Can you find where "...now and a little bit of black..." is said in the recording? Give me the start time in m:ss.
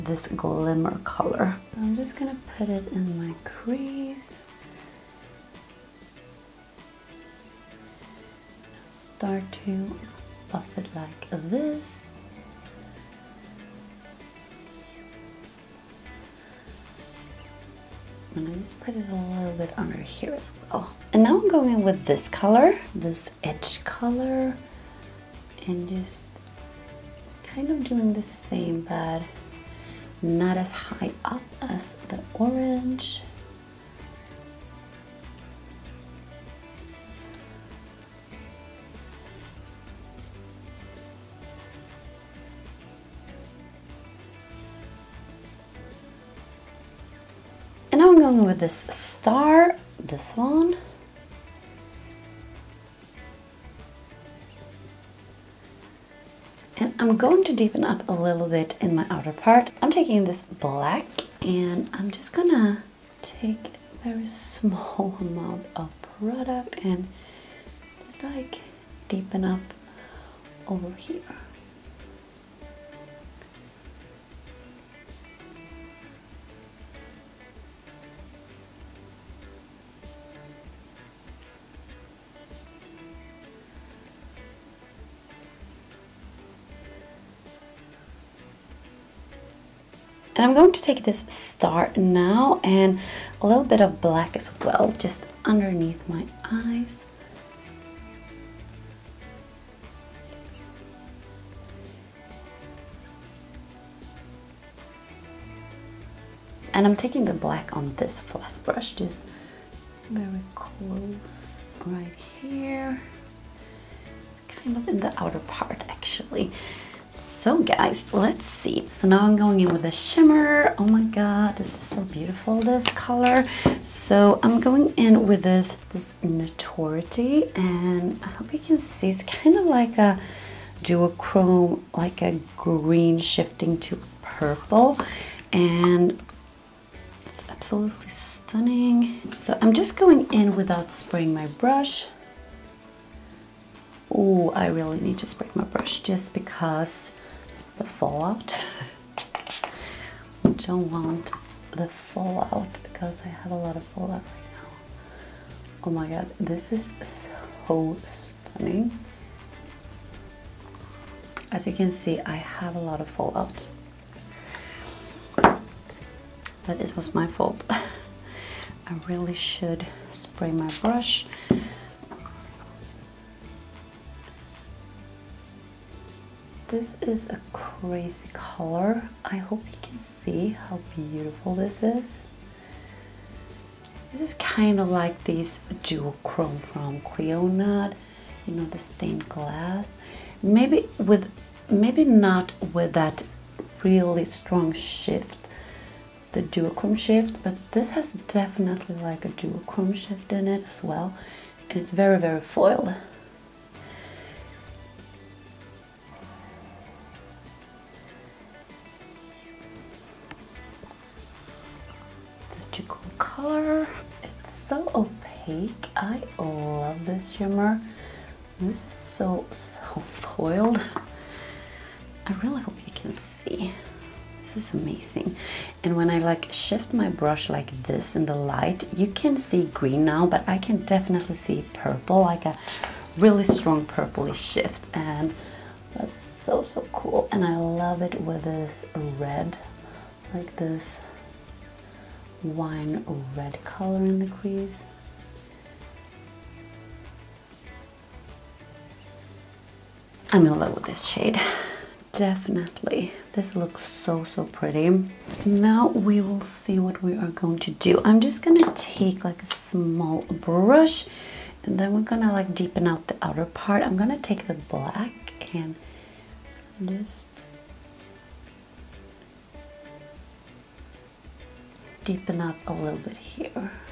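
1:31.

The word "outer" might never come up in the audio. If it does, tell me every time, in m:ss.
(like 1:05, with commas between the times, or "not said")
0:59, 1:55, 4:23.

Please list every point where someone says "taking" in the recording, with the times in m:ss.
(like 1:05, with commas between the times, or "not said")
0:59, 1:46.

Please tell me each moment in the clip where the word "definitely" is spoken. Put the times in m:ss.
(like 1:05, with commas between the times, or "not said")
3:18, 3:50, 4:12.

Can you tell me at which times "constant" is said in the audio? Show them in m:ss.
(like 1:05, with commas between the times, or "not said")
not said.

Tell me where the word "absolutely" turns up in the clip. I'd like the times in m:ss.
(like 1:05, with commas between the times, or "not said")
2:17.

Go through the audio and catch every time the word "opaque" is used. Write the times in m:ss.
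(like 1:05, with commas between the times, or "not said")
3:34.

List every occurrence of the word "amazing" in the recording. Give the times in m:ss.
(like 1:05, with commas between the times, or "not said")
3:44.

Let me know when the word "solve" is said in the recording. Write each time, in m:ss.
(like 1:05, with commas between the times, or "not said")
not said.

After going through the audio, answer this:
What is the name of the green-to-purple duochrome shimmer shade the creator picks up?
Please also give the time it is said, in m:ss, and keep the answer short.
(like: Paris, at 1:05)
Notority, at 2:06.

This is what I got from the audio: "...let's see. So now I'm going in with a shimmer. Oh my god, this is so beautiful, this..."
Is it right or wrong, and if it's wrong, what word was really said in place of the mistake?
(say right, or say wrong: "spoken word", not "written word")
right.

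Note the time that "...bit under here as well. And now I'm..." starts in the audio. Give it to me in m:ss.
0:19.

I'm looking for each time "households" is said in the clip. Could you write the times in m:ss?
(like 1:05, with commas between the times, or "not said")
not said.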